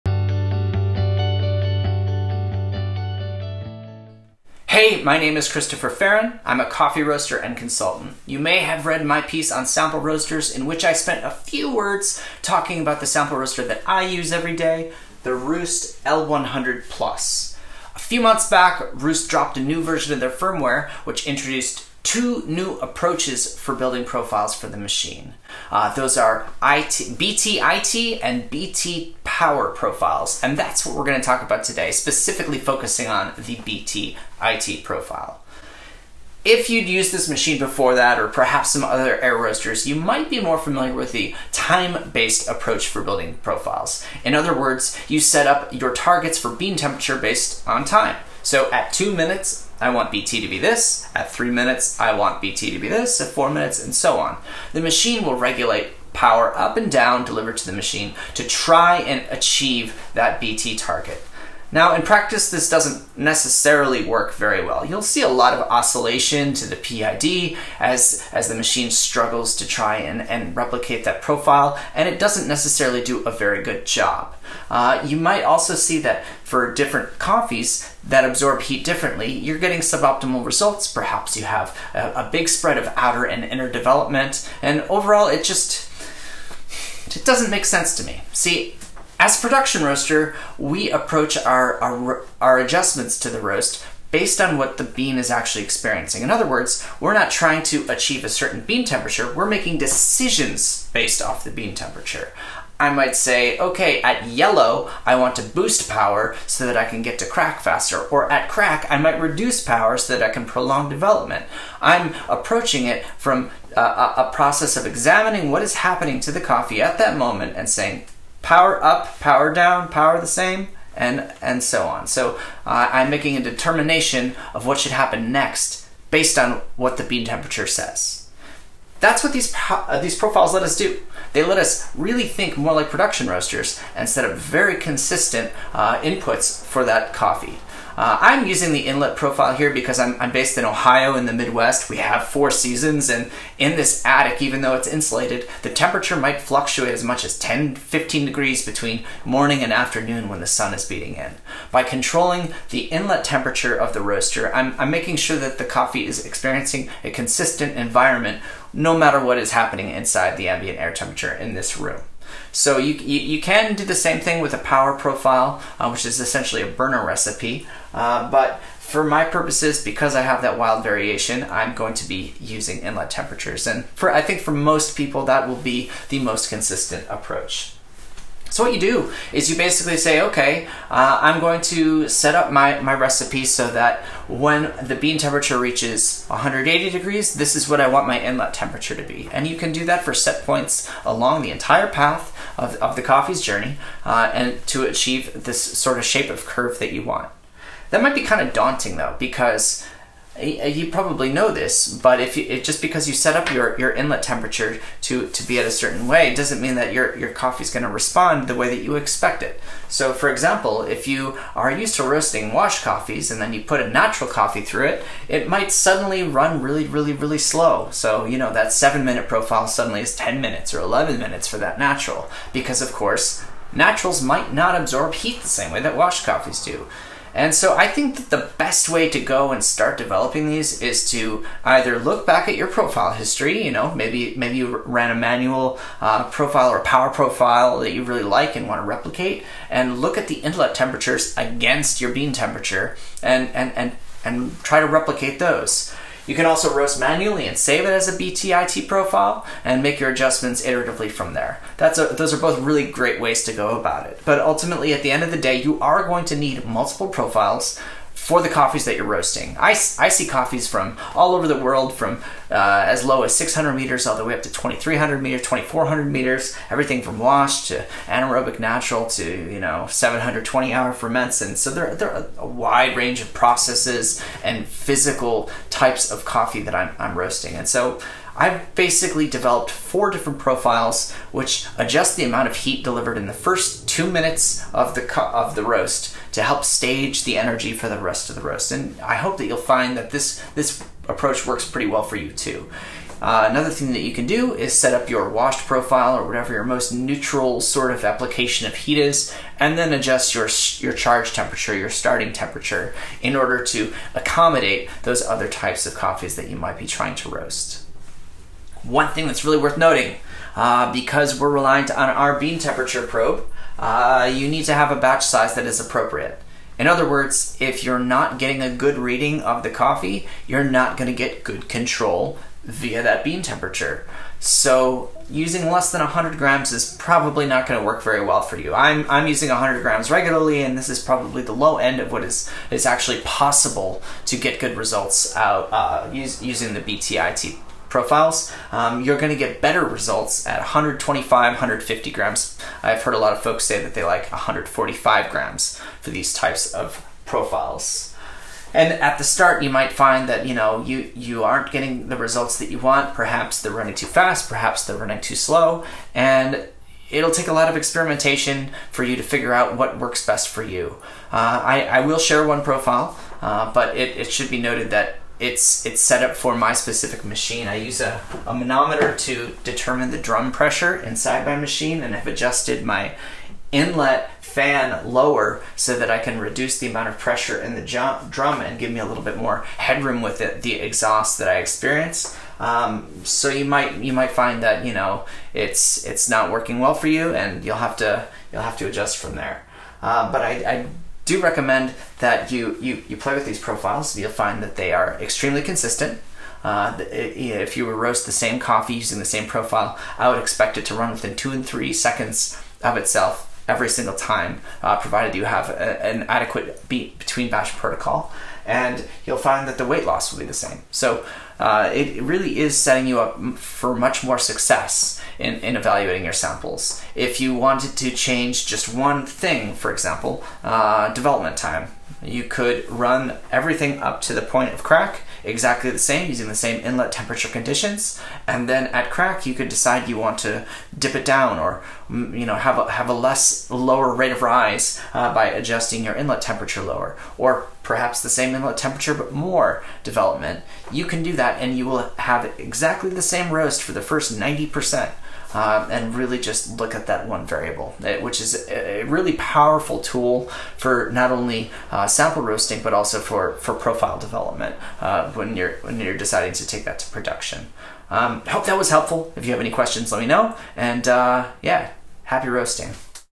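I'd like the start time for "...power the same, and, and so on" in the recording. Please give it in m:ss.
1:59.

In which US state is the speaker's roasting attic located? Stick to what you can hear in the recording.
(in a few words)
Ohio.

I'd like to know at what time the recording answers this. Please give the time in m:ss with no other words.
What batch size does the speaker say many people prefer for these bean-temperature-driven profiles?
5:44.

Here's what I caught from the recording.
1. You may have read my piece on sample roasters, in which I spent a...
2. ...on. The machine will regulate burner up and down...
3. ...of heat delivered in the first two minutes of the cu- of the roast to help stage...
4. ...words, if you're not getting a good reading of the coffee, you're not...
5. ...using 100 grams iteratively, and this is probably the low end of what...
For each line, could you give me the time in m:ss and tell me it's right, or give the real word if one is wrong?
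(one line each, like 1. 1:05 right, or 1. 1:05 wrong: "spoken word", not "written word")
1. 0:08 right
2. 0:54 wrong: "power", not "burner"
3. 4:42 right
4. 5:17 right
5. 5:29 wrong: "regularly", not "iteratively".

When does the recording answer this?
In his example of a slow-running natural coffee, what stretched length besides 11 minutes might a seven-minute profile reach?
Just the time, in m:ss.
3:40.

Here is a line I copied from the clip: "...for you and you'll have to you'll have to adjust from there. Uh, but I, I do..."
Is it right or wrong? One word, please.
right.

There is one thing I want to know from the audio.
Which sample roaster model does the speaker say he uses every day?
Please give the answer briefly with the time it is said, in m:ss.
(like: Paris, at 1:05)
ROEST L100 Plus, at 0:15.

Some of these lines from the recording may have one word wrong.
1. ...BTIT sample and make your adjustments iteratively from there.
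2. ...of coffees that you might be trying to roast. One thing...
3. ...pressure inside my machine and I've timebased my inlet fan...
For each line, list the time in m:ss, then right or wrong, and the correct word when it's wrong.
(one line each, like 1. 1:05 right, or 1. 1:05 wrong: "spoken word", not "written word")
1. 4:08 wrong: "profile", not "sample"
2. 5:05 right
3. 6:10 wrong: "adjusted", not "timebased".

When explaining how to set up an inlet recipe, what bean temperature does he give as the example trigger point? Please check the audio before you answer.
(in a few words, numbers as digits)
180 degrees.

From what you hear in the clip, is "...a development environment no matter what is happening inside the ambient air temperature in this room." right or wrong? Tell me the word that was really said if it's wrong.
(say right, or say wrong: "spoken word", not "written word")
wrong: "consistent", not "development".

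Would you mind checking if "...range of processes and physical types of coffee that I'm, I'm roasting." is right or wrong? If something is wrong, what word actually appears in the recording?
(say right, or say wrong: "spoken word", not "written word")
right.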